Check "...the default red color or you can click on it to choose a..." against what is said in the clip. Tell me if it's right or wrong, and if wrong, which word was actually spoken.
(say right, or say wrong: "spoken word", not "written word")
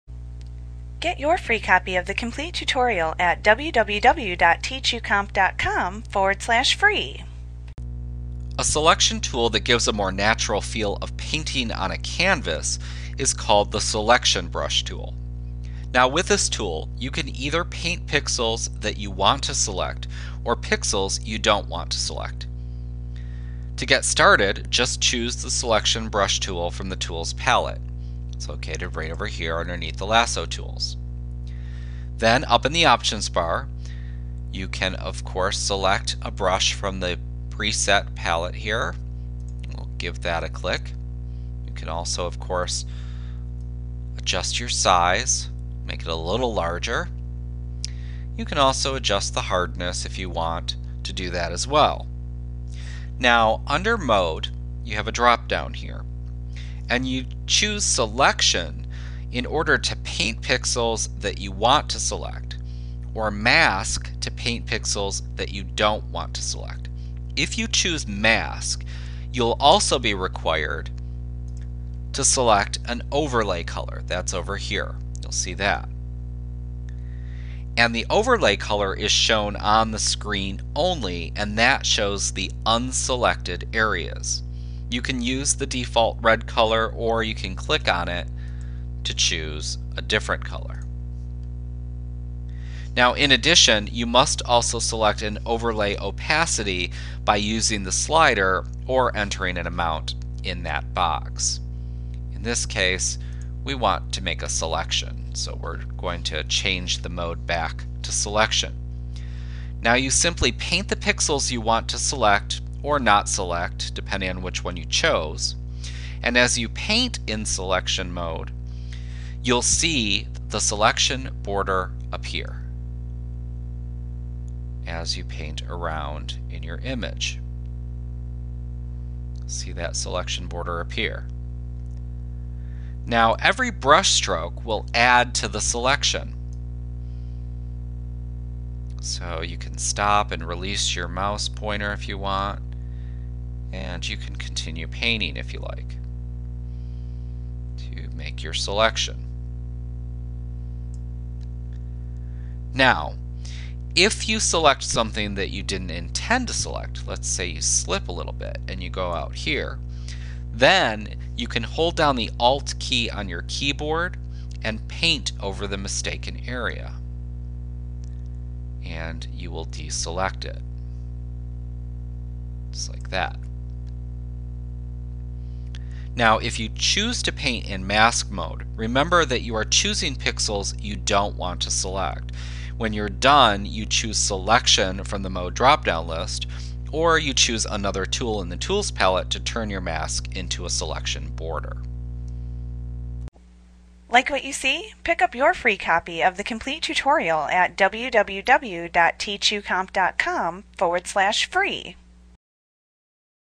right.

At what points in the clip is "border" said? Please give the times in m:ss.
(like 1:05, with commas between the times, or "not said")
2:01, 2:10, 3:11.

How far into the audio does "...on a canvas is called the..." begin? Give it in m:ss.
0:11.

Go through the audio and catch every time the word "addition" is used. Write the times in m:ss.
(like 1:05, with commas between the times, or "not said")
1:33.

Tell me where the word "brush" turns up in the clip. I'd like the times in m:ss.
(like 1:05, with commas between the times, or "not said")
0:14, 0:26, 0:36, 2:13.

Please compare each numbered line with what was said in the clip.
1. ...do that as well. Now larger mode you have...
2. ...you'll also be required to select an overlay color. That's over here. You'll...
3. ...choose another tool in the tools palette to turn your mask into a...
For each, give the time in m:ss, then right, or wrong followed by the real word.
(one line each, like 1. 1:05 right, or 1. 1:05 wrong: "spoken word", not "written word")
1. 0:51 wrong: "under", not "larger"
2. 1:09 right
3. 3:07 right.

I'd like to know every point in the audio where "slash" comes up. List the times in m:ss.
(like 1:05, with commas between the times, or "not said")
0:06, 3:21.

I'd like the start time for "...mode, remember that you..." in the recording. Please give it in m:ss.
2:58.